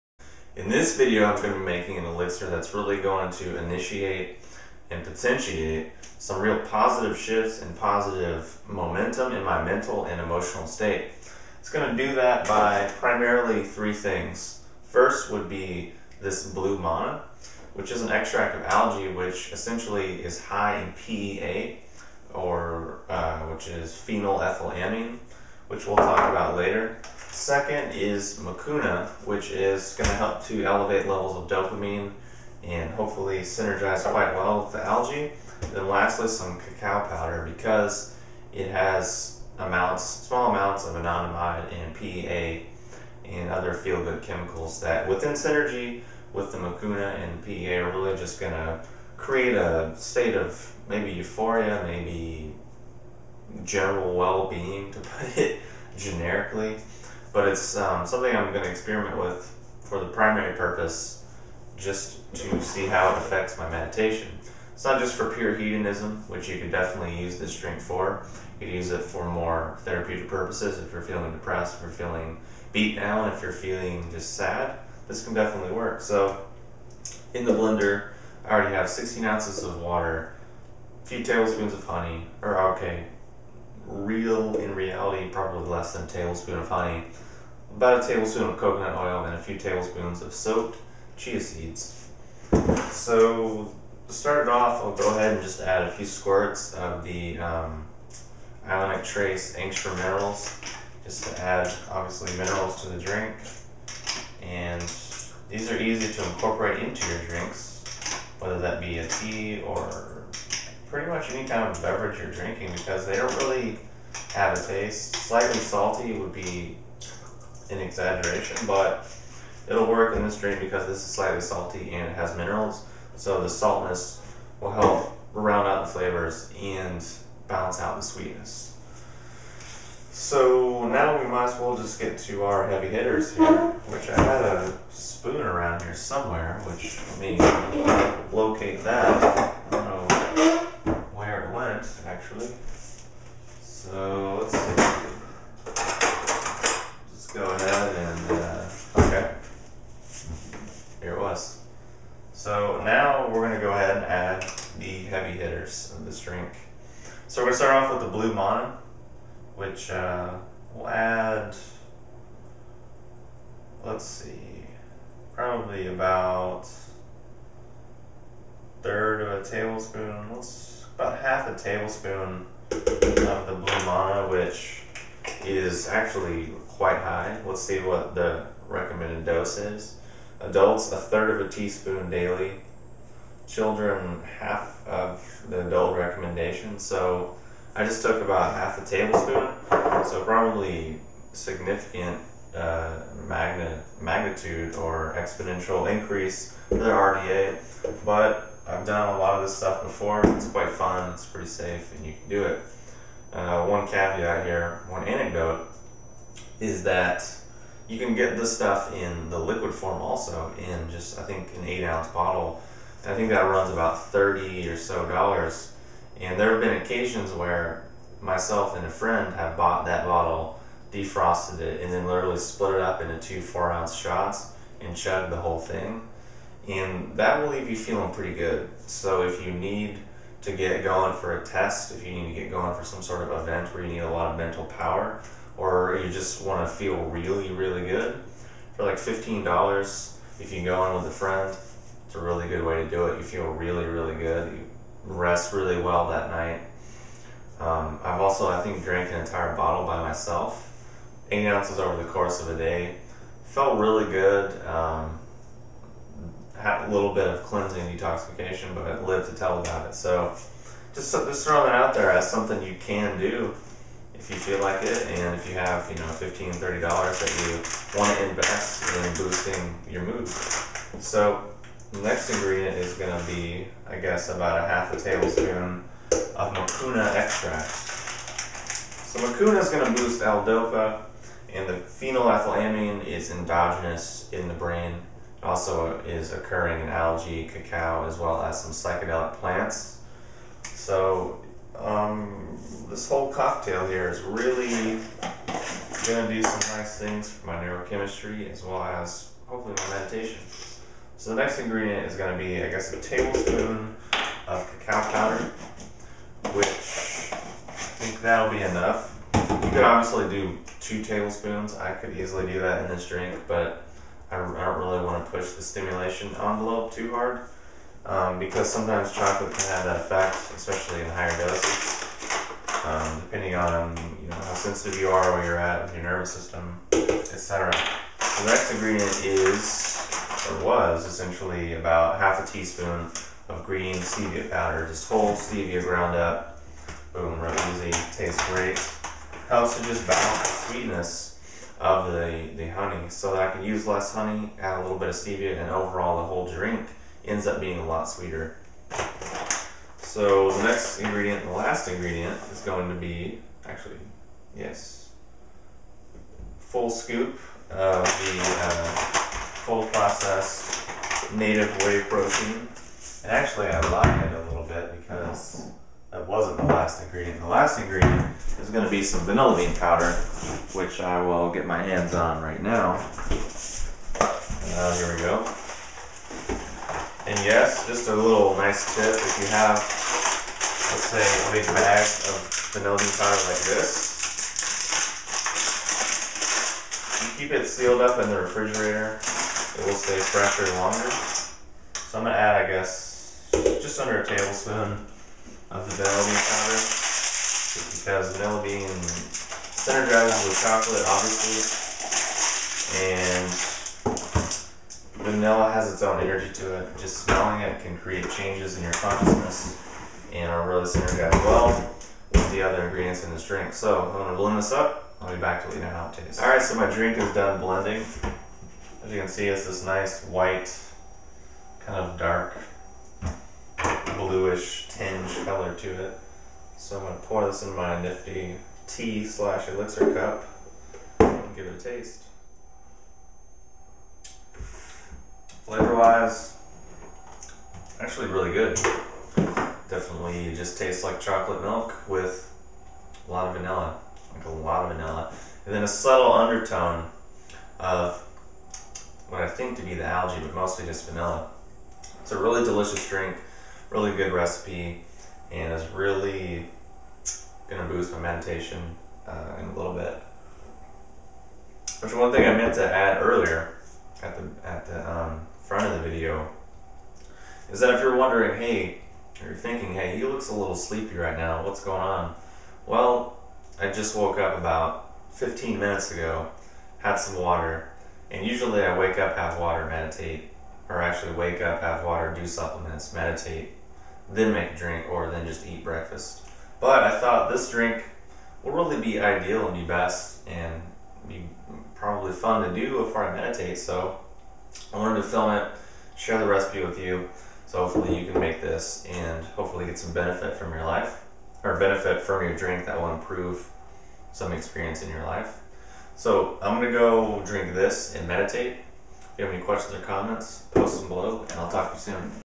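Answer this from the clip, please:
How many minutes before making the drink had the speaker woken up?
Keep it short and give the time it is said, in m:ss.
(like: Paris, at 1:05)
15, at 7:55.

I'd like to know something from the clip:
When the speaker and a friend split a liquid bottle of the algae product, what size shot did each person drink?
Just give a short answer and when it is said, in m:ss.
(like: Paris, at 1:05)
4 ounces, at 3:43.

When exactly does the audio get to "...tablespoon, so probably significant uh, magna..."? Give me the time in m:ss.
3:08.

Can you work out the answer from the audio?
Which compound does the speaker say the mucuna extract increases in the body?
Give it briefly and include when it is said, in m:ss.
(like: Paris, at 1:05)
L-DOPA, at 4:40.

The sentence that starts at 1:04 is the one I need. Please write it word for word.
It's not just for pure hedonism, which you could definitely use this drink for.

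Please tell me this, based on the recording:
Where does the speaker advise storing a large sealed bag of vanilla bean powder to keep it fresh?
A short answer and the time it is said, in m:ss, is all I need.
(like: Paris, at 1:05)
refrigerator, at 6:28.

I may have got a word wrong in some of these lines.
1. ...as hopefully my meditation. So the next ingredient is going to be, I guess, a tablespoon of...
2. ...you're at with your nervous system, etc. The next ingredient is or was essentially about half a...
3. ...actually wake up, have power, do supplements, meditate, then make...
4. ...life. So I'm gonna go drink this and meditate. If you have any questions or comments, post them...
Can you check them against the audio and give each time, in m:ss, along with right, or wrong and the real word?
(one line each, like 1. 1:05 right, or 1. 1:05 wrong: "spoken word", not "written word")
1. 4:58 right
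2. 5:25 right
3. 8:01 wrong: "water", not "power"
4. 8:25 right.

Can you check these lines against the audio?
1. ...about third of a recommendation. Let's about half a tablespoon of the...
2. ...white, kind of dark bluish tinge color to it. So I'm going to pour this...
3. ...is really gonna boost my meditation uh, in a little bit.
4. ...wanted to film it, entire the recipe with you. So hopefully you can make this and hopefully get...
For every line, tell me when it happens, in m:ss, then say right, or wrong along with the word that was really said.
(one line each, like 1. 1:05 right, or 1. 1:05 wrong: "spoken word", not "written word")
1. 2:45 wrong: "tablespoon", not "recommendation"
2. 7:00 right
3. 7:35 right
4. 8:14 wrong: "share", not "entire".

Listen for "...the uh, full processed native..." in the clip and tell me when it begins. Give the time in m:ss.
5:58.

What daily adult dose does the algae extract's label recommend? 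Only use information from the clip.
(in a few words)
a third of a teaspoon.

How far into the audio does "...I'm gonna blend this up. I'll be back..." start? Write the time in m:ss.
6:54.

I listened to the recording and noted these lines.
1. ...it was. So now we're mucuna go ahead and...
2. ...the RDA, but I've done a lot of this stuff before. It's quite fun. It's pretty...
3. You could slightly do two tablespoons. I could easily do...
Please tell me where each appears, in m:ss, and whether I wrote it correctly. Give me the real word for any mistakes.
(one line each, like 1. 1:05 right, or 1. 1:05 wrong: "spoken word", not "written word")
1. 2:31 wrong: "gonna", not "mucuna"
2. 3:16 right
3. 5:09 wrong: "obviously", not "slightly".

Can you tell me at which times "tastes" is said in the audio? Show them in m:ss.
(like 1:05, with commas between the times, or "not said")
1:54, 5:38, 6:56, 7:11, 7:20.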